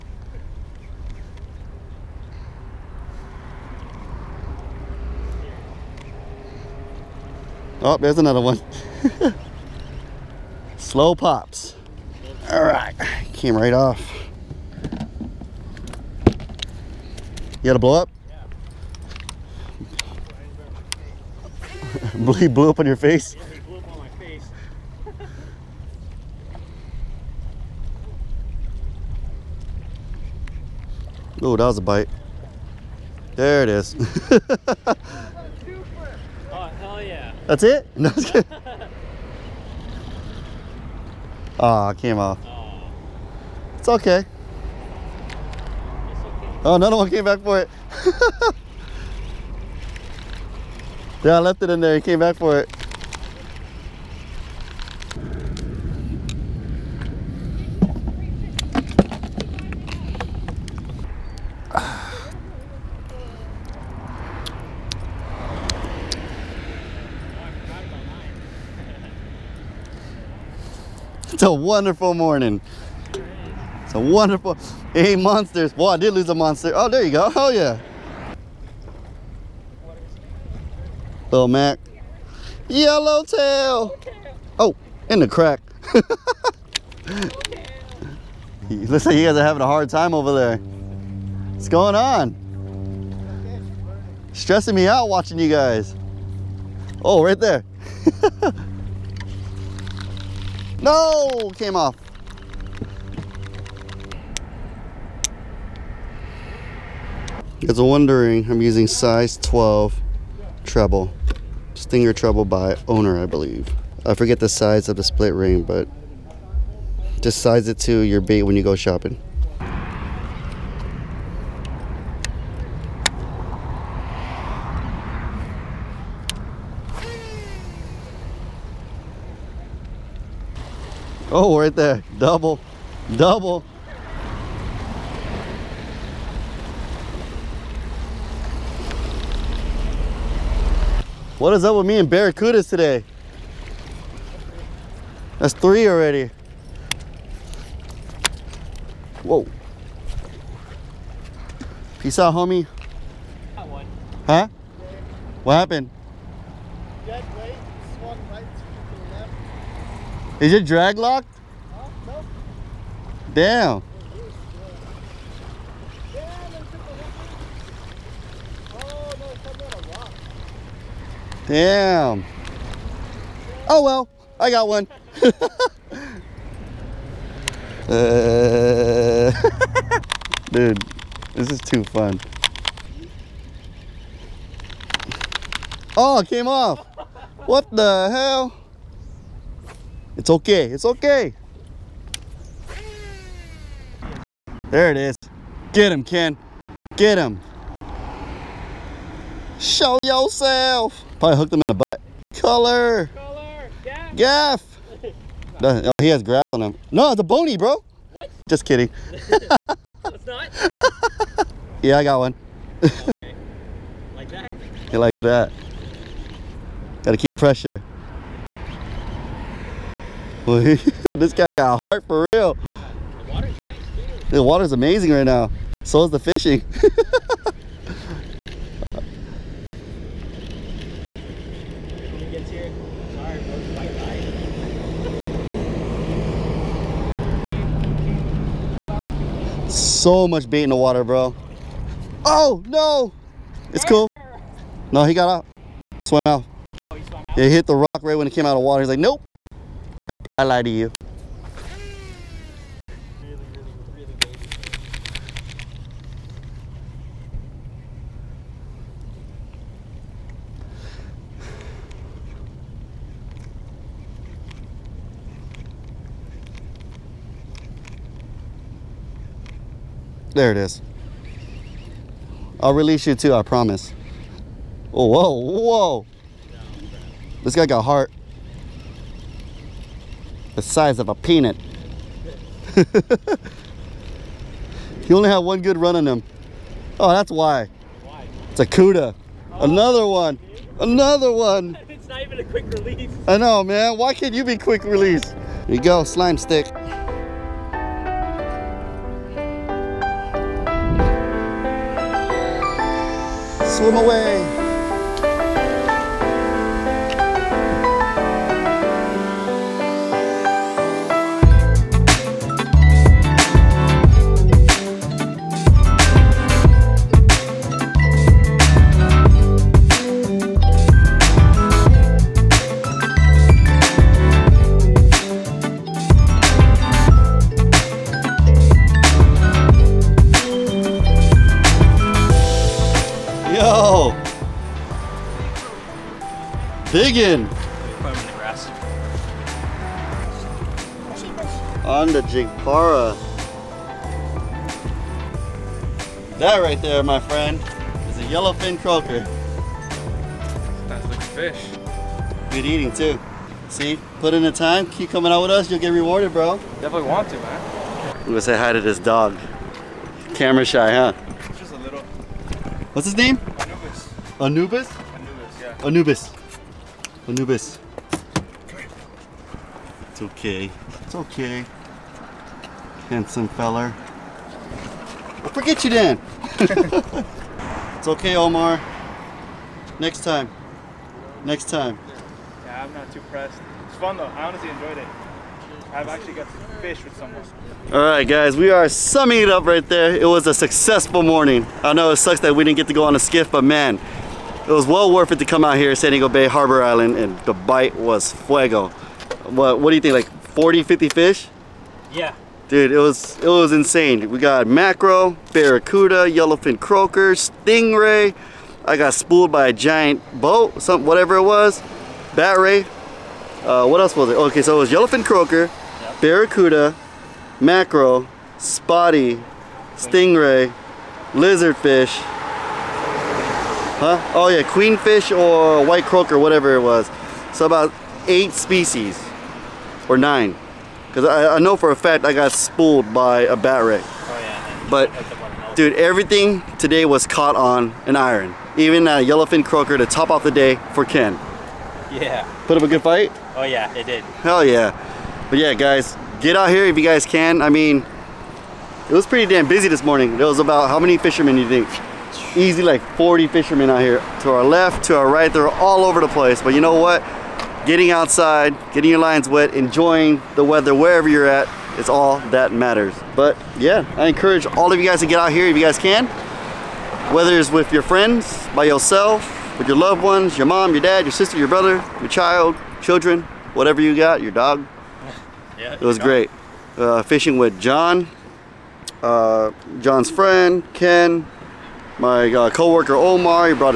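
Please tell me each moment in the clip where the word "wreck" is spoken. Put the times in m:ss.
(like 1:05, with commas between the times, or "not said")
7:13.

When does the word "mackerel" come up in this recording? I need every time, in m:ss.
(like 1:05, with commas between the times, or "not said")
6:44, 6:57.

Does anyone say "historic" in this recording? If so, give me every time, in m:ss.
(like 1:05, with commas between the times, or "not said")
not said.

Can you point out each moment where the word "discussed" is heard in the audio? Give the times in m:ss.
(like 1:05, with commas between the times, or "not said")
not said.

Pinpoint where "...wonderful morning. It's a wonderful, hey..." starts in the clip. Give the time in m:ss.
1:11.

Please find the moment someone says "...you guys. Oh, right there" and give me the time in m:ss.
1:35.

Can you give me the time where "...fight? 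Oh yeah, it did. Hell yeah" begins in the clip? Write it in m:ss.
7:23.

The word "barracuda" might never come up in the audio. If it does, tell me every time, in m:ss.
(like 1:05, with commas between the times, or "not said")
2:22, 6:45, 6:56.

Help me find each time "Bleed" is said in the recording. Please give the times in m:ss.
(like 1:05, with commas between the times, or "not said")
0:22.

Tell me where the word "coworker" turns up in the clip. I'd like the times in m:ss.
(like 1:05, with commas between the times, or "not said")
8:02.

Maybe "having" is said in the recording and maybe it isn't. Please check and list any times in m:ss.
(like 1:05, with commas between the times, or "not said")
1:29.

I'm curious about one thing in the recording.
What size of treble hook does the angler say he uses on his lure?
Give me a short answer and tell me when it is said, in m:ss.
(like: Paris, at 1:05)
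12, at 1:48.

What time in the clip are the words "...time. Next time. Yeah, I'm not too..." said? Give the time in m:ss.
6:20.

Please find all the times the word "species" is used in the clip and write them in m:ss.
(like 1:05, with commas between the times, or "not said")
7:08.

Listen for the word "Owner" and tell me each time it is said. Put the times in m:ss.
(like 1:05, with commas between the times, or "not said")
1:52.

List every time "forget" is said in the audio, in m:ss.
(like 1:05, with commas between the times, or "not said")
1:54, 6:15.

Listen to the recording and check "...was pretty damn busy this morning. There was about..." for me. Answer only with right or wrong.
right.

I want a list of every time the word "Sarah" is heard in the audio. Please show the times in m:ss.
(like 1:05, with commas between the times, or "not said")
not said.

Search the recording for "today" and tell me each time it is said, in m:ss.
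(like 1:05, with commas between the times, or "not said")
2:22, 7:16.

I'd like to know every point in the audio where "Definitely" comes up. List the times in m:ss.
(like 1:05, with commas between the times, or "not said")
5:56.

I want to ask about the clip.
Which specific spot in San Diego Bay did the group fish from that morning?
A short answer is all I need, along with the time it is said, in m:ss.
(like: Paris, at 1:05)
Harbor Island, at 6:36.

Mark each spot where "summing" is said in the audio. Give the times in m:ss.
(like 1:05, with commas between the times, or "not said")
6:28.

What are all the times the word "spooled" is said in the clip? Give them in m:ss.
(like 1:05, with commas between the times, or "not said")
6:49, 7:12.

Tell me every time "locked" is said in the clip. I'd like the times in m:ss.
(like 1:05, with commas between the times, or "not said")
2:40.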